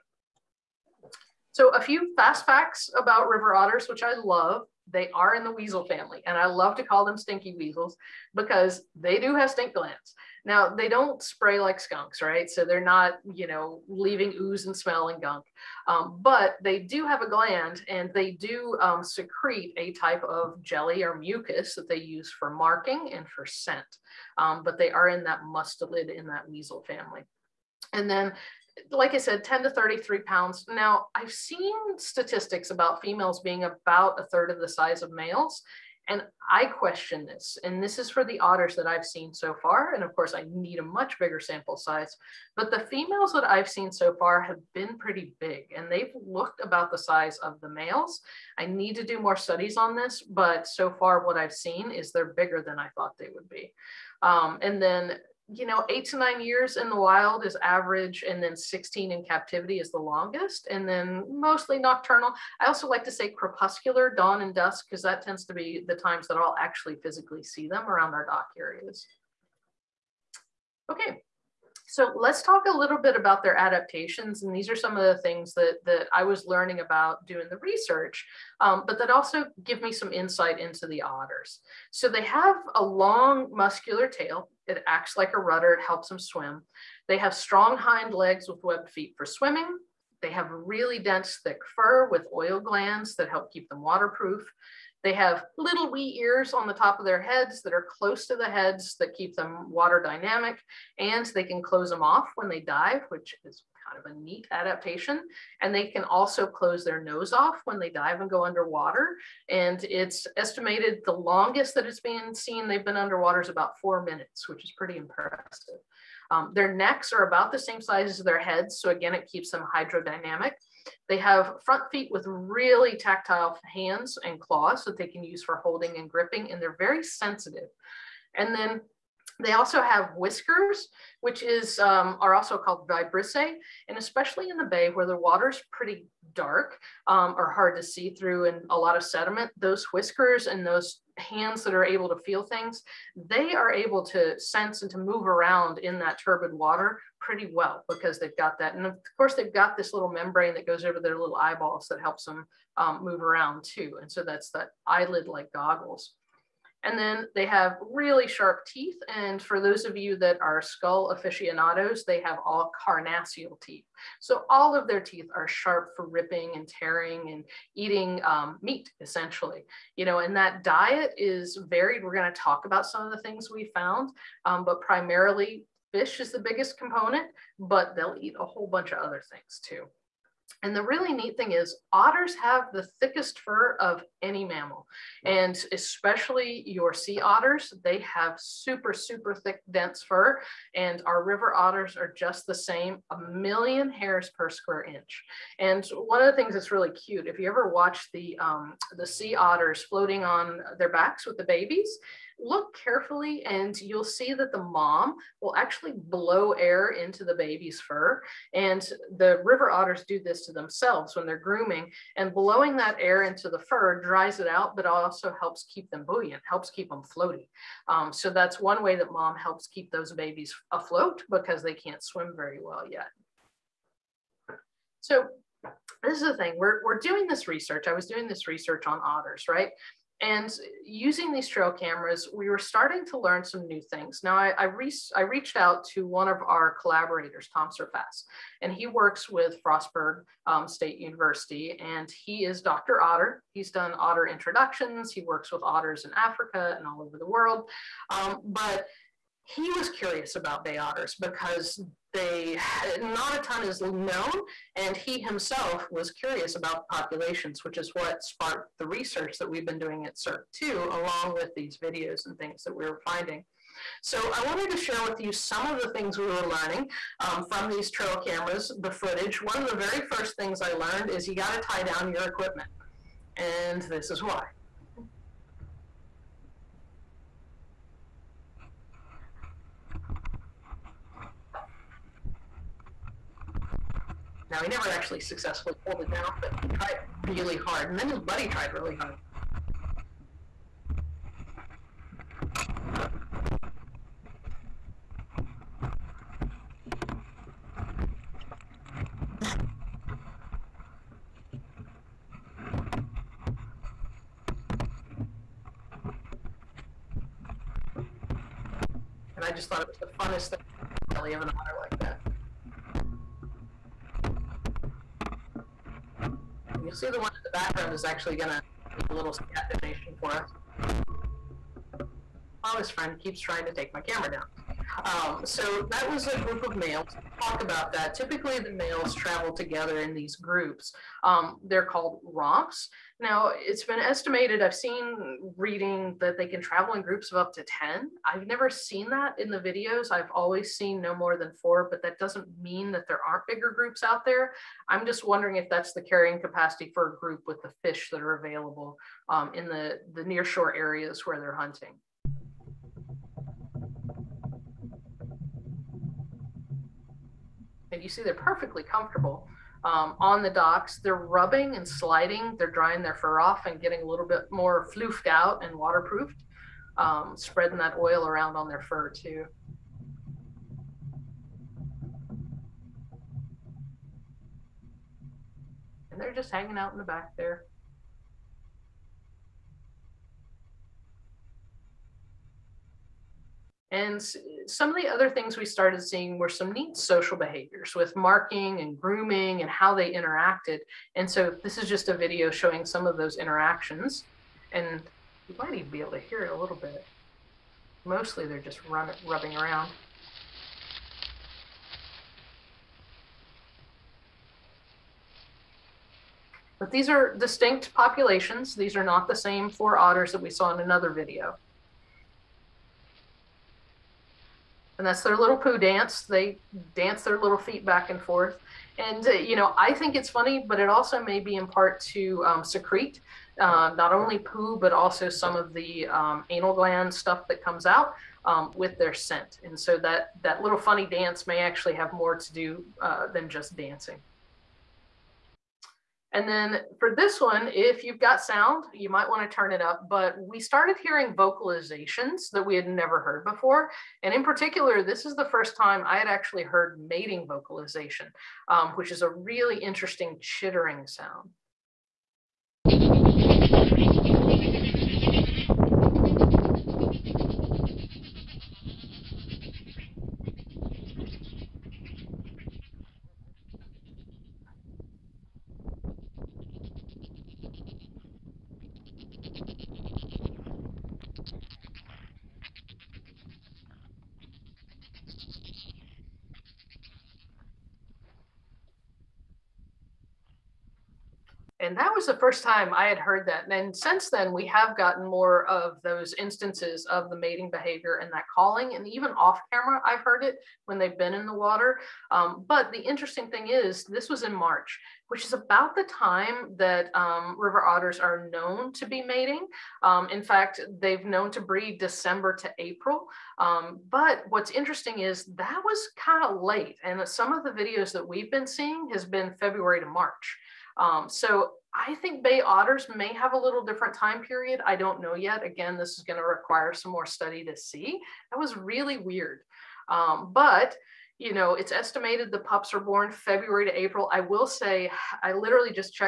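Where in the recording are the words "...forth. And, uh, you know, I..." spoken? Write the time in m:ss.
6:58.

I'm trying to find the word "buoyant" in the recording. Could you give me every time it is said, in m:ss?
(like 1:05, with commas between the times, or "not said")
3:36.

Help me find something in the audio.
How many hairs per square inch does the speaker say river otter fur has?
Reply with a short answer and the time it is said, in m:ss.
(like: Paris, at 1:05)
a million, at 3:13.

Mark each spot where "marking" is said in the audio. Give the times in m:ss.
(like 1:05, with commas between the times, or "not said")
0:22, 6:28.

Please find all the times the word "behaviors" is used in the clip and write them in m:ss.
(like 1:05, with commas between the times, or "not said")
6:27, 8:07.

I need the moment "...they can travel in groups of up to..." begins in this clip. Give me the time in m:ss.
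5:36.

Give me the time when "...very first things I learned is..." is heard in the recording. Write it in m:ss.
4:29.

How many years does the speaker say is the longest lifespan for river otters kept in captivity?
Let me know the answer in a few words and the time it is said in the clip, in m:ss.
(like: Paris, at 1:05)
16, at 0:58.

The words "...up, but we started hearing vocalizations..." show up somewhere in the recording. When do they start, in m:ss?
7:19.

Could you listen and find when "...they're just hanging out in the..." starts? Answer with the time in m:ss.
6:16.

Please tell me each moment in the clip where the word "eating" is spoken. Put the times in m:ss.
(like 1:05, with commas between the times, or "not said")
2:47.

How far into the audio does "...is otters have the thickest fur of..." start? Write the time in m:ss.
3:01.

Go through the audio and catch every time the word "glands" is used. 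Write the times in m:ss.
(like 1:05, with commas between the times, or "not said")
0:09, 0:17, 1:32, 7:06.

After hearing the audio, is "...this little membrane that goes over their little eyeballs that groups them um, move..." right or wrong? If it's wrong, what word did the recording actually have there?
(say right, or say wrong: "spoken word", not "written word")
wrong: "helps", not "groups".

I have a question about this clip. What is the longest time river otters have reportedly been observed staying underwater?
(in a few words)
about 4 minutes.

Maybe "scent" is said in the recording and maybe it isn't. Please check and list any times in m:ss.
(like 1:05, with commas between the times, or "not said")
0:23, 7:09.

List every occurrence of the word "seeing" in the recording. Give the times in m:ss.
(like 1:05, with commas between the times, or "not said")
6:26, 8:28.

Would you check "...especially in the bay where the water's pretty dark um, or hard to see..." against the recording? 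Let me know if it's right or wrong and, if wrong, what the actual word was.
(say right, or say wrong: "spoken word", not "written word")
right.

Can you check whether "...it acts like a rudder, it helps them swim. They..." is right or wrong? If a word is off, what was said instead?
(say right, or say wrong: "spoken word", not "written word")
right.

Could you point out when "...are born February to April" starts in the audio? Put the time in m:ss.
8:42.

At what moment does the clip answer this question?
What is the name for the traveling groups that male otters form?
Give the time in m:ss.
5:32.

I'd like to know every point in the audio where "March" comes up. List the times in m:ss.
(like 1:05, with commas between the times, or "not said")
8:14, 8:30.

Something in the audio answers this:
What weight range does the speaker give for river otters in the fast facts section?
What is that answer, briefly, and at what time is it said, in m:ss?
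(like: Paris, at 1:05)
10 to 33 pounds, at 0:29.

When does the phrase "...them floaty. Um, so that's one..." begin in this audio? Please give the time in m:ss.
3:36.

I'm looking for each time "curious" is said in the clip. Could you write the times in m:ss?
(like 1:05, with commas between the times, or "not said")
4:09, 4:16.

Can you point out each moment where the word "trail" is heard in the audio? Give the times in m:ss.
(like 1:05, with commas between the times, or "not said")
3:51, 4:27.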